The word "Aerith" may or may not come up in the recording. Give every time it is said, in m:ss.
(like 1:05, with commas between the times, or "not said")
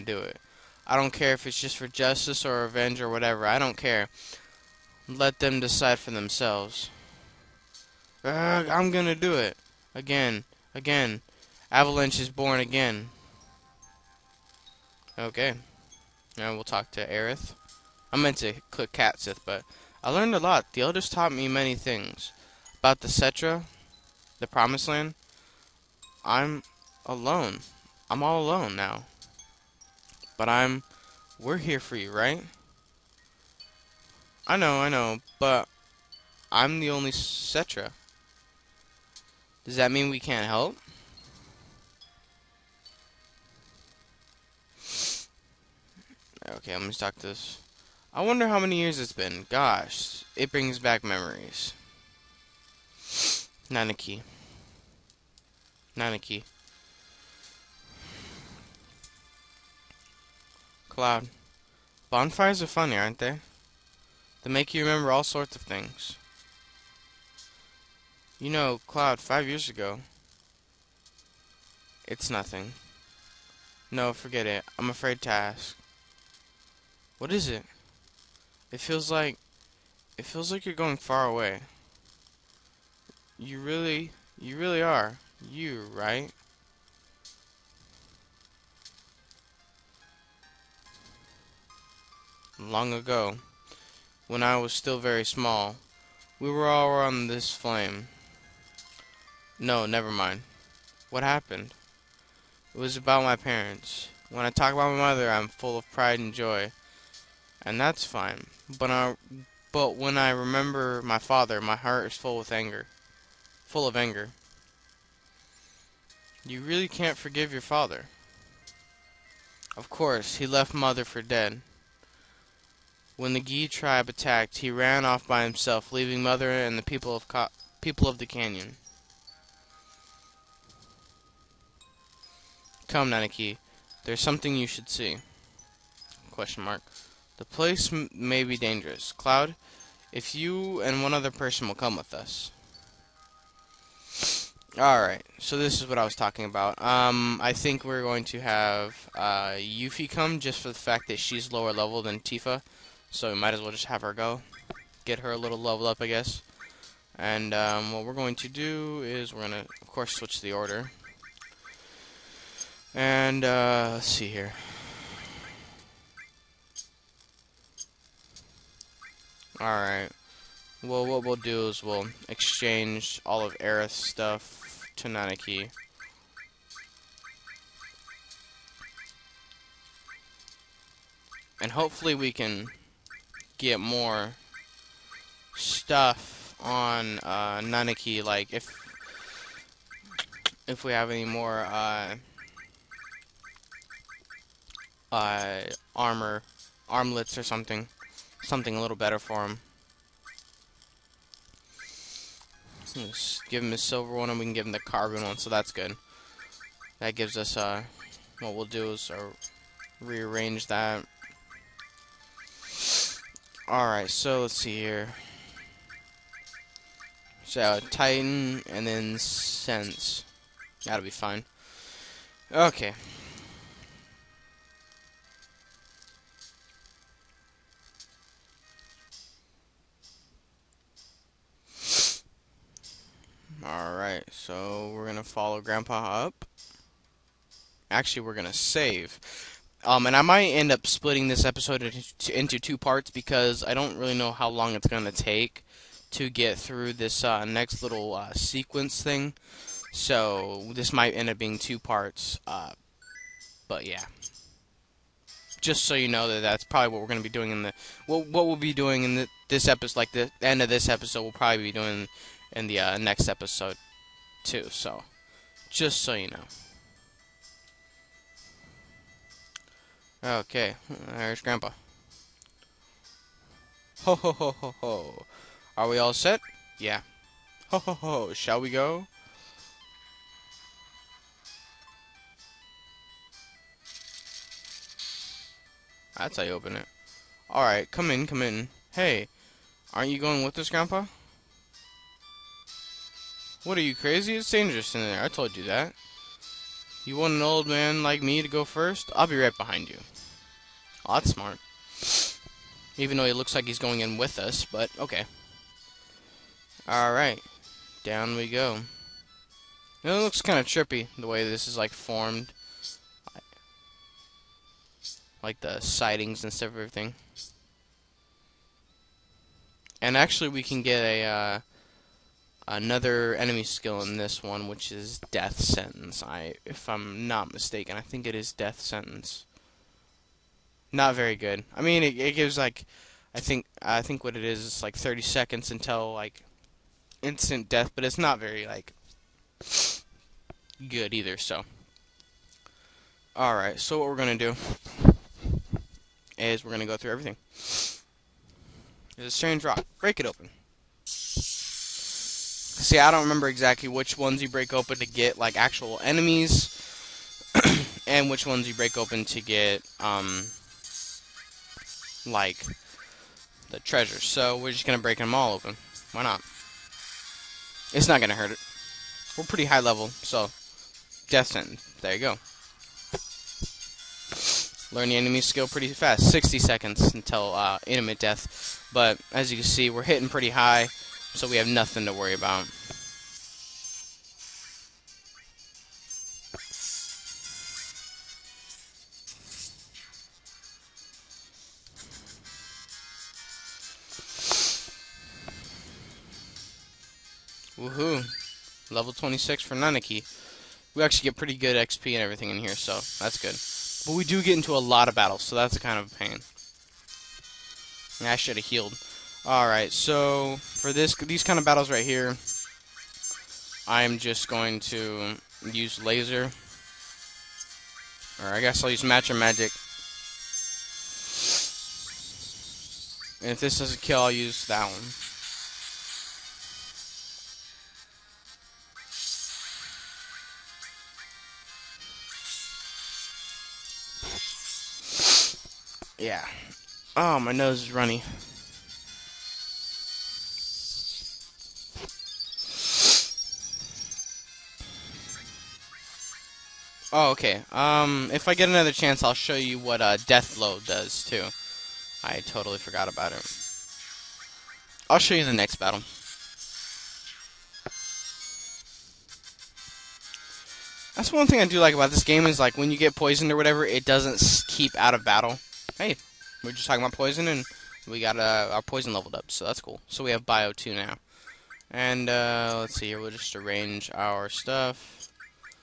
0:17, 2:53.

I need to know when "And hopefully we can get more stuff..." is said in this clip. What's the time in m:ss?
3:01.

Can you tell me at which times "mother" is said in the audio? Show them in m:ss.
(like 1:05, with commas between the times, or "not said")
1:44, 2:00, 2:06.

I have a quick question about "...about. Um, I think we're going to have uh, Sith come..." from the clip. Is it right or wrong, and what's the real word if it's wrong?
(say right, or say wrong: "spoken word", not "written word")
wrong: "Yuffie", not "Sith".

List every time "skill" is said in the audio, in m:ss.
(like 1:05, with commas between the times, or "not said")
5:23, 6:15.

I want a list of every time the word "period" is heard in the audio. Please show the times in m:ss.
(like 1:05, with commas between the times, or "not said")
not said.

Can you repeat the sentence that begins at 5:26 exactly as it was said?
I, if I'm not mistaken, I think it is Death Sentence.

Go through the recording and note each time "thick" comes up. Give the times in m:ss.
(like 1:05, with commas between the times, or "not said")
not said.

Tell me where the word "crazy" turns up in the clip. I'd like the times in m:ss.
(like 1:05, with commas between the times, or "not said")
4:53.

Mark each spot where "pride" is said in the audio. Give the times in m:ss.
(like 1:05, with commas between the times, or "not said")
1:45.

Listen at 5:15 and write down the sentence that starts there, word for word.
Like the sightings and stuff, everything.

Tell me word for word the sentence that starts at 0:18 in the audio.
I meant to click Cait Sith, but I learned a lot.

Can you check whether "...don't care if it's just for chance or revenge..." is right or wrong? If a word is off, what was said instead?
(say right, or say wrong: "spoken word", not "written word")
wrong: "justice", not "chance".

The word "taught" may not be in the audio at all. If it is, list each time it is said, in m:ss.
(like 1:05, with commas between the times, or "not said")
0:21.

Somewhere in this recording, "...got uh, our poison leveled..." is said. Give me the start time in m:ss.
7:48.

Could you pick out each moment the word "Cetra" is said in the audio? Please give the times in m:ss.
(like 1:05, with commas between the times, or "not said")
0:23, 0:37.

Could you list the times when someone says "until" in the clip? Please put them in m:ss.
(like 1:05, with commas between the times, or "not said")
5:35, 6:17.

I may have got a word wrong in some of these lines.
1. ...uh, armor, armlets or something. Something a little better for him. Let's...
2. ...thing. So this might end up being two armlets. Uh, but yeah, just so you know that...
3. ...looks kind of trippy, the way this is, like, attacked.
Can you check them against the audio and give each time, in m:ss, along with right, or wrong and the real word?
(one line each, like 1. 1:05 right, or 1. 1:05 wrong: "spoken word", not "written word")
1. 3:15 right
2. 4:09 wrong: "parts", not "armlets"
3. 5:10 wrong: "formed", not "attacked".